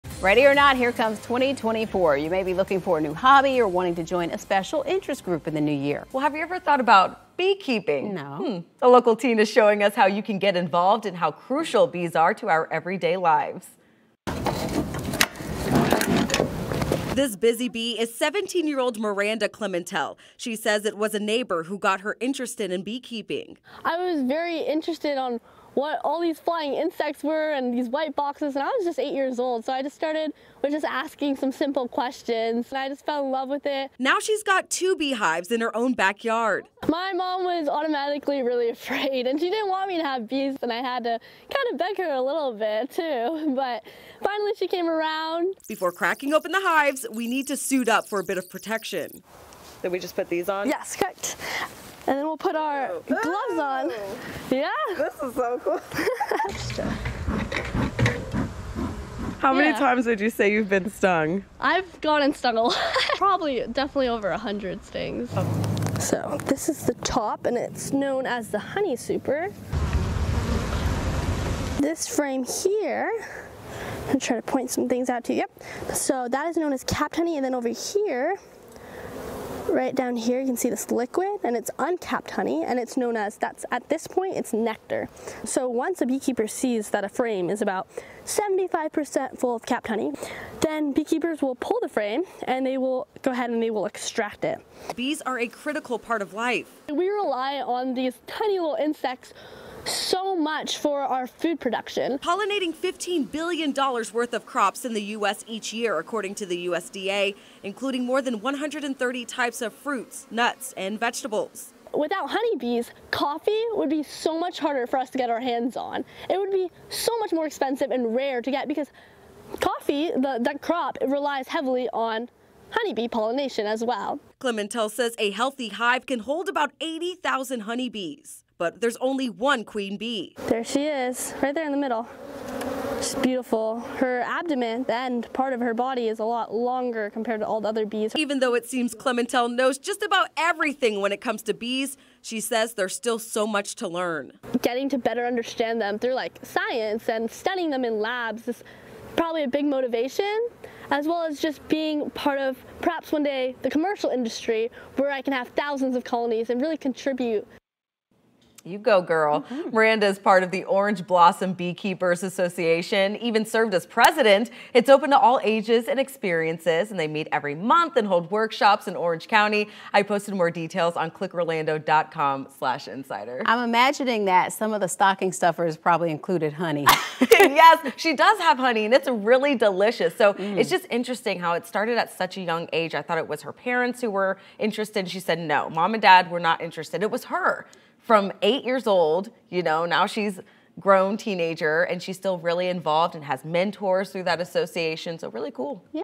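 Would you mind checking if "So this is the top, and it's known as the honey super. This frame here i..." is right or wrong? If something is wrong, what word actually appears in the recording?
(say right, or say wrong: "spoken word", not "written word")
right.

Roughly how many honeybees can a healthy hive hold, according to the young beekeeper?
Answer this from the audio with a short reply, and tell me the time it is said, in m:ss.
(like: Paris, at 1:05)
80,000, at 2:06.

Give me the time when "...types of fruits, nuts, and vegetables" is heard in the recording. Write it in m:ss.
1:49.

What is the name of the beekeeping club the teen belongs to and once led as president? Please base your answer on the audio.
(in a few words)
Orange Blossom Beekeepers Association.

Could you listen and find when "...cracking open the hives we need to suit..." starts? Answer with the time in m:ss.
0:45.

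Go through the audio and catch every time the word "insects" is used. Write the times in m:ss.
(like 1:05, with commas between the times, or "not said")
0:26, 1:38.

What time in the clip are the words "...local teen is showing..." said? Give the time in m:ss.
0:08.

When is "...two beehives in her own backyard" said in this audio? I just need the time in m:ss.
0:34.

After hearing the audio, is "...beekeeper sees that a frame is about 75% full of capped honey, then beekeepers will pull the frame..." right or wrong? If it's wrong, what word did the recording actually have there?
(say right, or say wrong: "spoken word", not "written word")
right.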